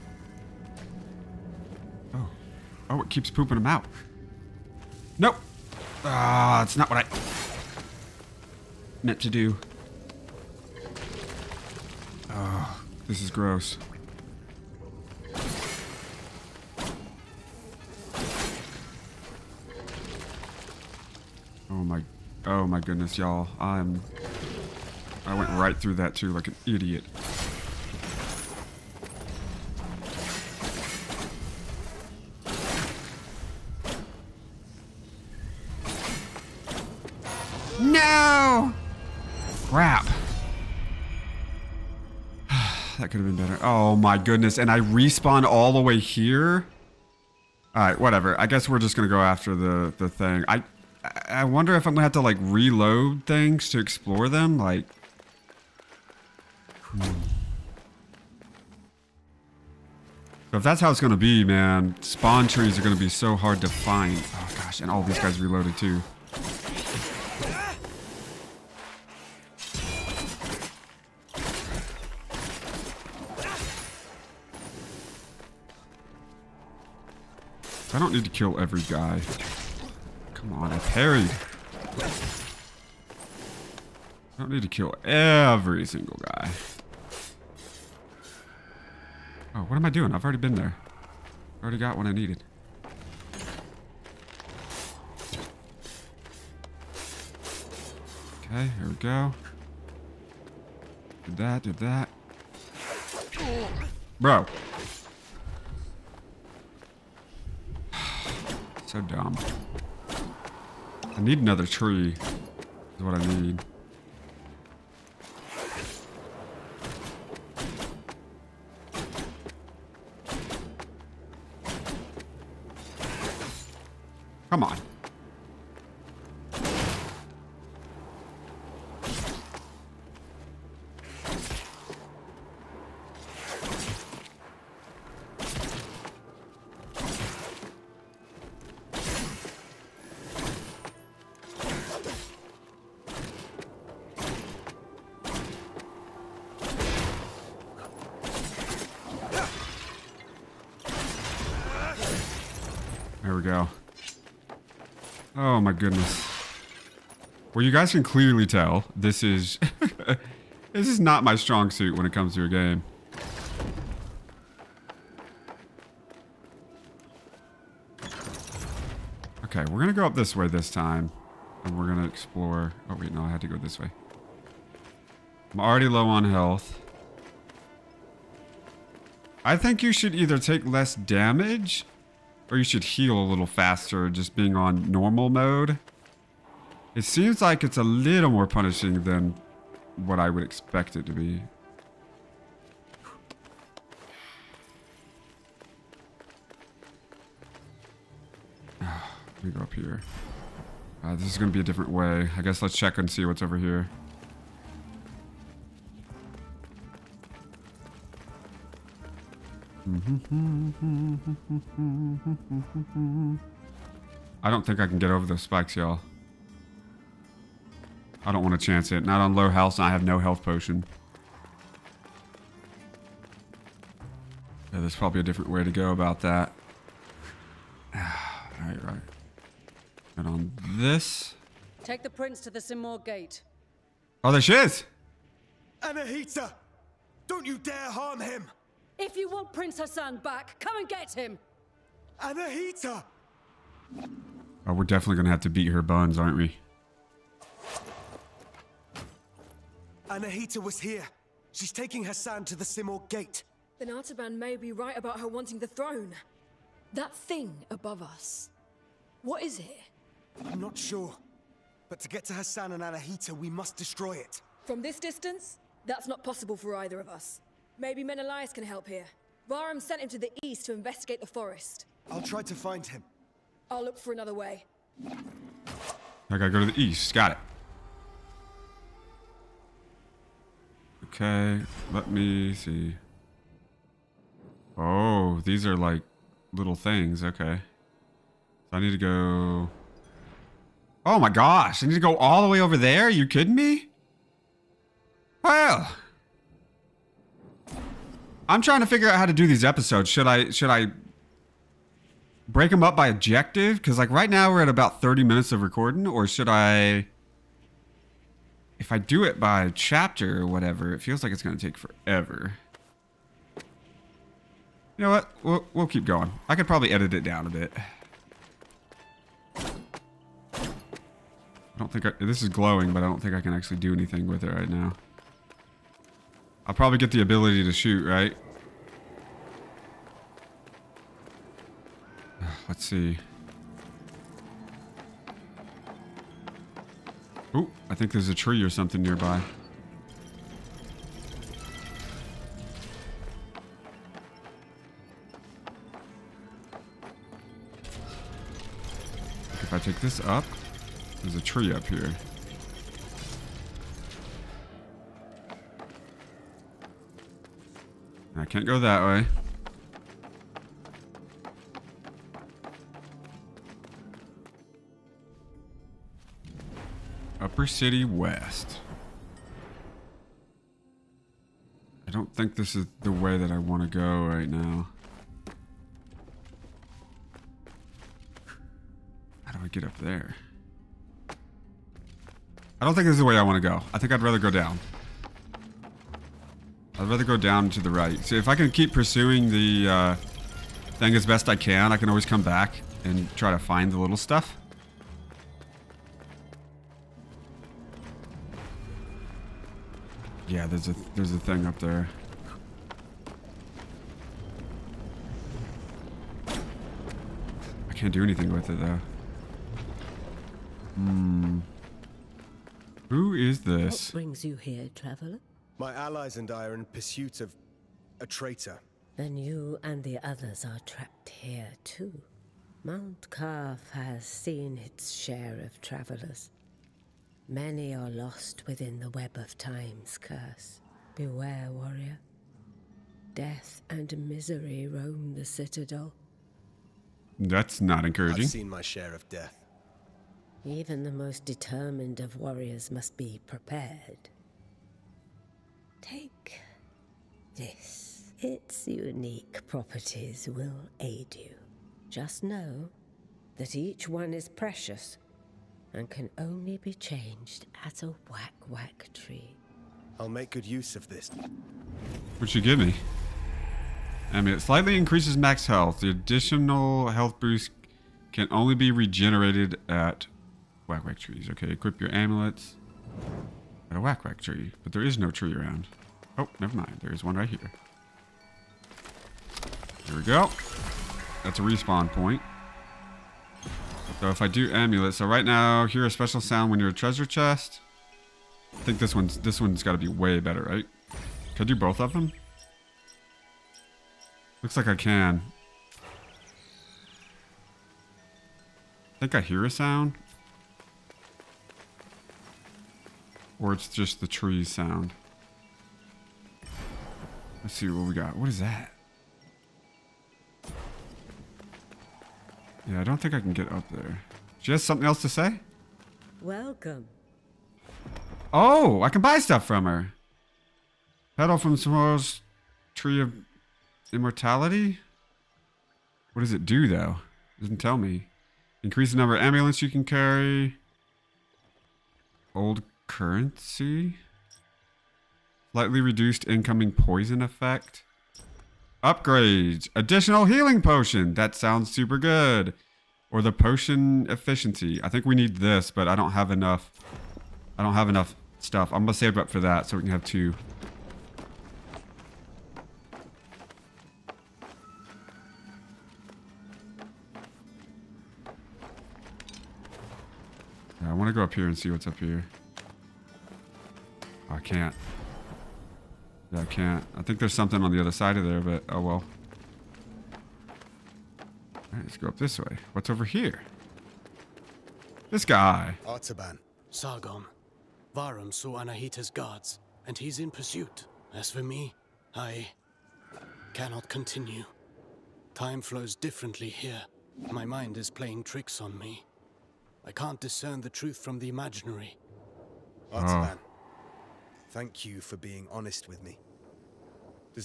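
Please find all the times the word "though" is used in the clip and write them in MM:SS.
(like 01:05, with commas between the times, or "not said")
06:48, 08:46.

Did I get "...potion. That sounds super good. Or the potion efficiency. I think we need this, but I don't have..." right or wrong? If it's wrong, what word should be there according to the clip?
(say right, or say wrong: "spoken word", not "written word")
right.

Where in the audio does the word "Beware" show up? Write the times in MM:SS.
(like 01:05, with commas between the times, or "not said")
07:11.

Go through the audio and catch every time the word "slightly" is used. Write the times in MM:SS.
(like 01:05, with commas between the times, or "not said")
07:44, 08:55.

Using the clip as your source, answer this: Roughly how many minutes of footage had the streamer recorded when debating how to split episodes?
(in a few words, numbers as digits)
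30.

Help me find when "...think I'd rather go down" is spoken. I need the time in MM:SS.
06:23.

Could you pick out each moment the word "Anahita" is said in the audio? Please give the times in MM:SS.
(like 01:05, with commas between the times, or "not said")
03:55, 04:02, 04:10, 04:22, 09:38.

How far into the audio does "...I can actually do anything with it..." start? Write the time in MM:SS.
05:23.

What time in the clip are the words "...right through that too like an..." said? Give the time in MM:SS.
00:25.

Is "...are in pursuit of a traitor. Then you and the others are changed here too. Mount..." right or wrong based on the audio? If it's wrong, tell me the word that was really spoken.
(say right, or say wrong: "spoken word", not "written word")
wrong: "trapped", not "changed".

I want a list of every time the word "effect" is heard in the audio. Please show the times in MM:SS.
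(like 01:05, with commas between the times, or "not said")
08:57.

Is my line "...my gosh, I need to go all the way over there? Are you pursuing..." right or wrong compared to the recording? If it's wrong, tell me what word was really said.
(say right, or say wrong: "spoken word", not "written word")
wrong: "kidding", not "pursuing".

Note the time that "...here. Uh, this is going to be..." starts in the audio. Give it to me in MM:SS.
03:19.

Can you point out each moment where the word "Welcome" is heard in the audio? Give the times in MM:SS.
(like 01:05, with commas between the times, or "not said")
08:36.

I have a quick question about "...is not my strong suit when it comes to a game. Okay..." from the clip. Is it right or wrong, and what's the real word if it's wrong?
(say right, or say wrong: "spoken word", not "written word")
right.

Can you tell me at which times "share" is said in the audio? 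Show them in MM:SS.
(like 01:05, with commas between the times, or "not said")
07:05, 07:18.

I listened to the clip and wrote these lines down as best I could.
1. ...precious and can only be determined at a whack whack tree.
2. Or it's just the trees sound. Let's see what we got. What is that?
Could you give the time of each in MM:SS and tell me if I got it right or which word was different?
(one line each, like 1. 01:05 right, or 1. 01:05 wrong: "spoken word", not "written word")
1. 07:34 wrong: "changed", not "determined"
2. 08:23 right.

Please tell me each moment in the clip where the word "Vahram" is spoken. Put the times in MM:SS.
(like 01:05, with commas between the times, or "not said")
04:29, 09:38.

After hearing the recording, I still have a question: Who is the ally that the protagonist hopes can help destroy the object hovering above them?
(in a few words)
Menolias.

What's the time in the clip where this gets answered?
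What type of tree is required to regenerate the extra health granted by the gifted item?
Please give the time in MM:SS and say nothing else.
07:50.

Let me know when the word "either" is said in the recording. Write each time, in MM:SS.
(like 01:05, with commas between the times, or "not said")
03:00, 04:26.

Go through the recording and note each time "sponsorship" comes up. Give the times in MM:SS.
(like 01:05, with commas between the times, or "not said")
not said.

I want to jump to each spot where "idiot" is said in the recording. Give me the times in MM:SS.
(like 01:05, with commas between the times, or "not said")
00:26.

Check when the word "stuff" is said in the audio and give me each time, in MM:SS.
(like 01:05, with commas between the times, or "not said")
06:34, 08:39, 09:08.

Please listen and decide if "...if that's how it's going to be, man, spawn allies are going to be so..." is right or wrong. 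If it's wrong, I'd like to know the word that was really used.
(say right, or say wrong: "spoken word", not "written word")
wrong: "trees", not "allies".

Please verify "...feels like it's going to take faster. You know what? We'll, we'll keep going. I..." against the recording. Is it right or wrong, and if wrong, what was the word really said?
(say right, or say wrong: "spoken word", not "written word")
wrong: "forever", not "faster".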